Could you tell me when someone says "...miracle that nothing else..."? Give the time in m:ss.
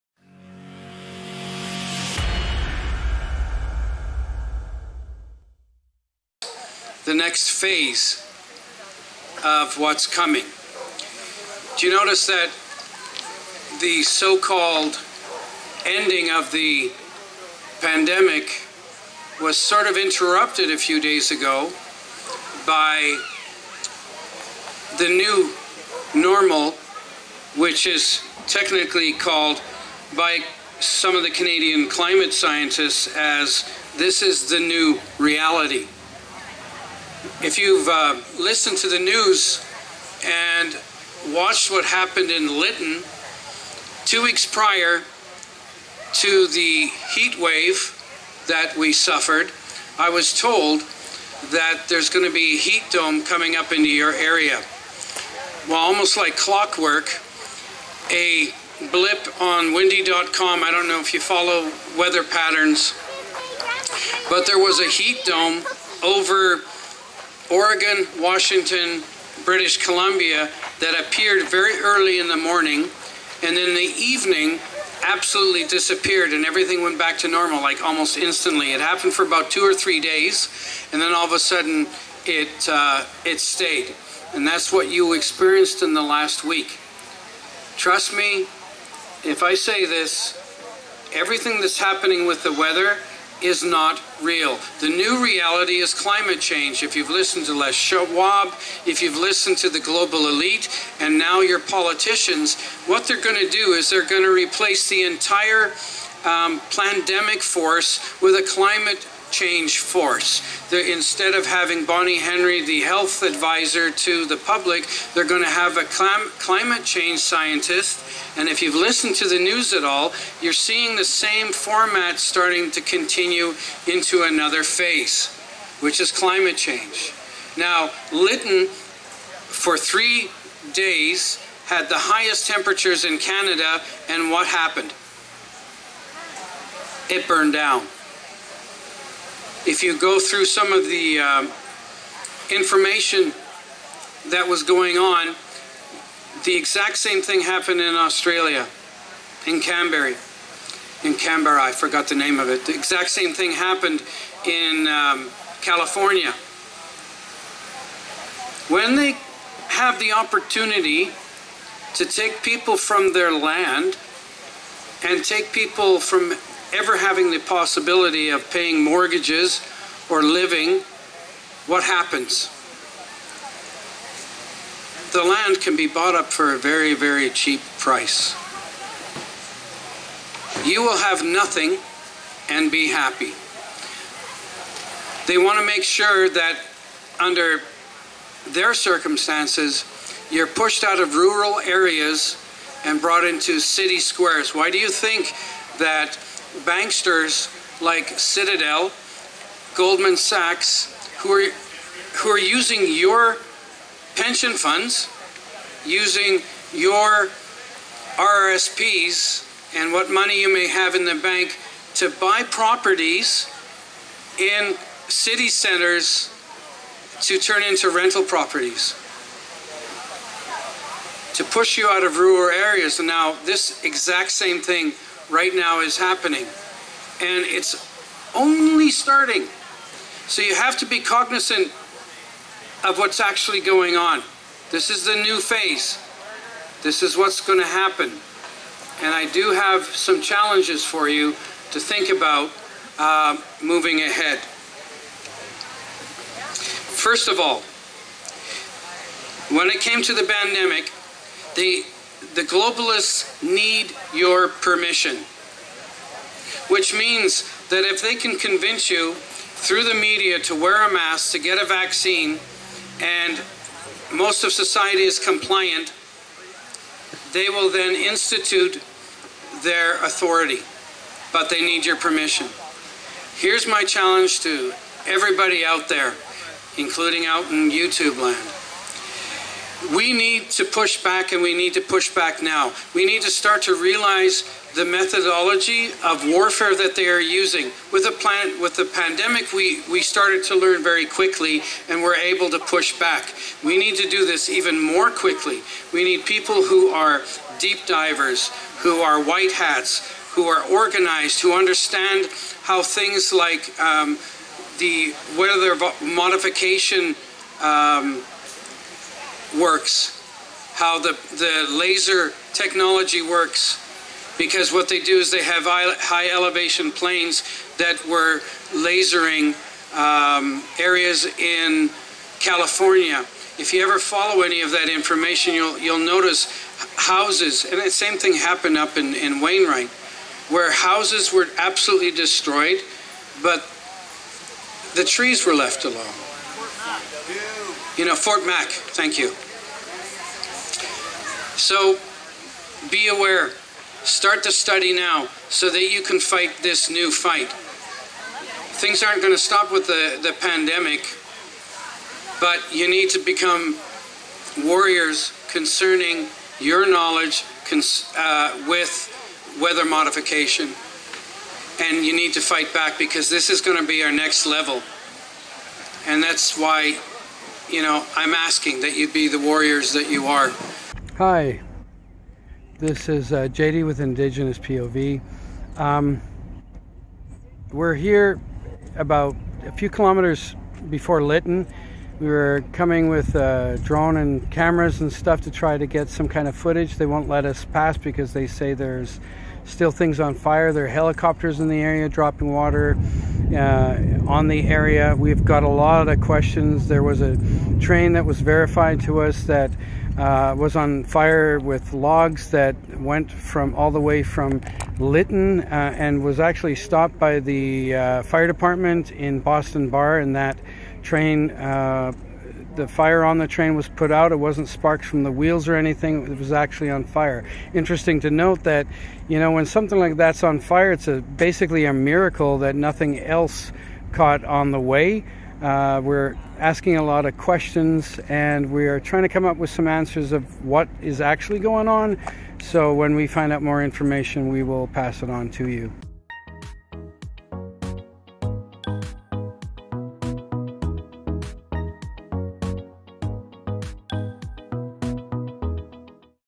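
7:01.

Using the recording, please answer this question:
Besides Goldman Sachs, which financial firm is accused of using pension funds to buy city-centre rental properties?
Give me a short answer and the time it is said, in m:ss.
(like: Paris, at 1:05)
Citadel, at 3:18.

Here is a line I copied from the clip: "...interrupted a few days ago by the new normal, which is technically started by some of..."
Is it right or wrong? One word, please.
wrong.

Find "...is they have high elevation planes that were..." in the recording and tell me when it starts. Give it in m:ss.
5:15.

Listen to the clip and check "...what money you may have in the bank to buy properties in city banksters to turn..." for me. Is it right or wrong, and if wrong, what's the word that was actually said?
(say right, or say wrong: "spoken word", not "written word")
wrong: "centers", not "banksters".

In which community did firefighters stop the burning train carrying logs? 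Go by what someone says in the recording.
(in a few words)
Boston Bar.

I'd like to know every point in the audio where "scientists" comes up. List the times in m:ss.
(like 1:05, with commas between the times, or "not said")
0:32, 1:57.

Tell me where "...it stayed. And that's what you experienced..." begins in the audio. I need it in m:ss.
1:23.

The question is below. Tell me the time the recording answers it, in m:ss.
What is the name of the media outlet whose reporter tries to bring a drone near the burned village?
6:13.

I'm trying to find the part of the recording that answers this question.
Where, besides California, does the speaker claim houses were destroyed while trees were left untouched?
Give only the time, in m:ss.
5:29.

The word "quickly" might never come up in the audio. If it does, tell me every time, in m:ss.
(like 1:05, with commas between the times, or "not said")
4:51, 4:55.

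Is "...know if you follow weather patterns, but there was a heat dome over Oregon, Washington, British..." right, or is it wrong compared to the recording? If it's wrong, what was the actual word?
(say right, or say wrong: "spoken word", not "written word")
right.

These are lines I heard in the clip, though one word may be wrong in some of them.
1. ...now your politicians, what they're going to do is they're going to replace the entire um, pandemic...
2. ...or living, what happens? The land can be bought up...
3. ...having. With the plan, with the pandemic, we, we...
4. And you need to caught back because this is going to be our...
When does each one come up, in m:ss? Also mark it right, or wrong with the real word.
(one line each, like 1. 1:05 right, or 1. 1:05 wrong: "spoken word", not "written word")
1. 1:41 right
2. 2:50 right
3. 4:47 wrong: "using", not "having"
4. 6:01 wrong: "fight", not "caught".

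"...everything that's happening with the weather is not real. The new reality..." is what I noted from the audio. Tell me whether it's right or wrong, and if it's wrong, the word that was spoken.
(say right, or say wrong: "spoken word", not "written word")
right.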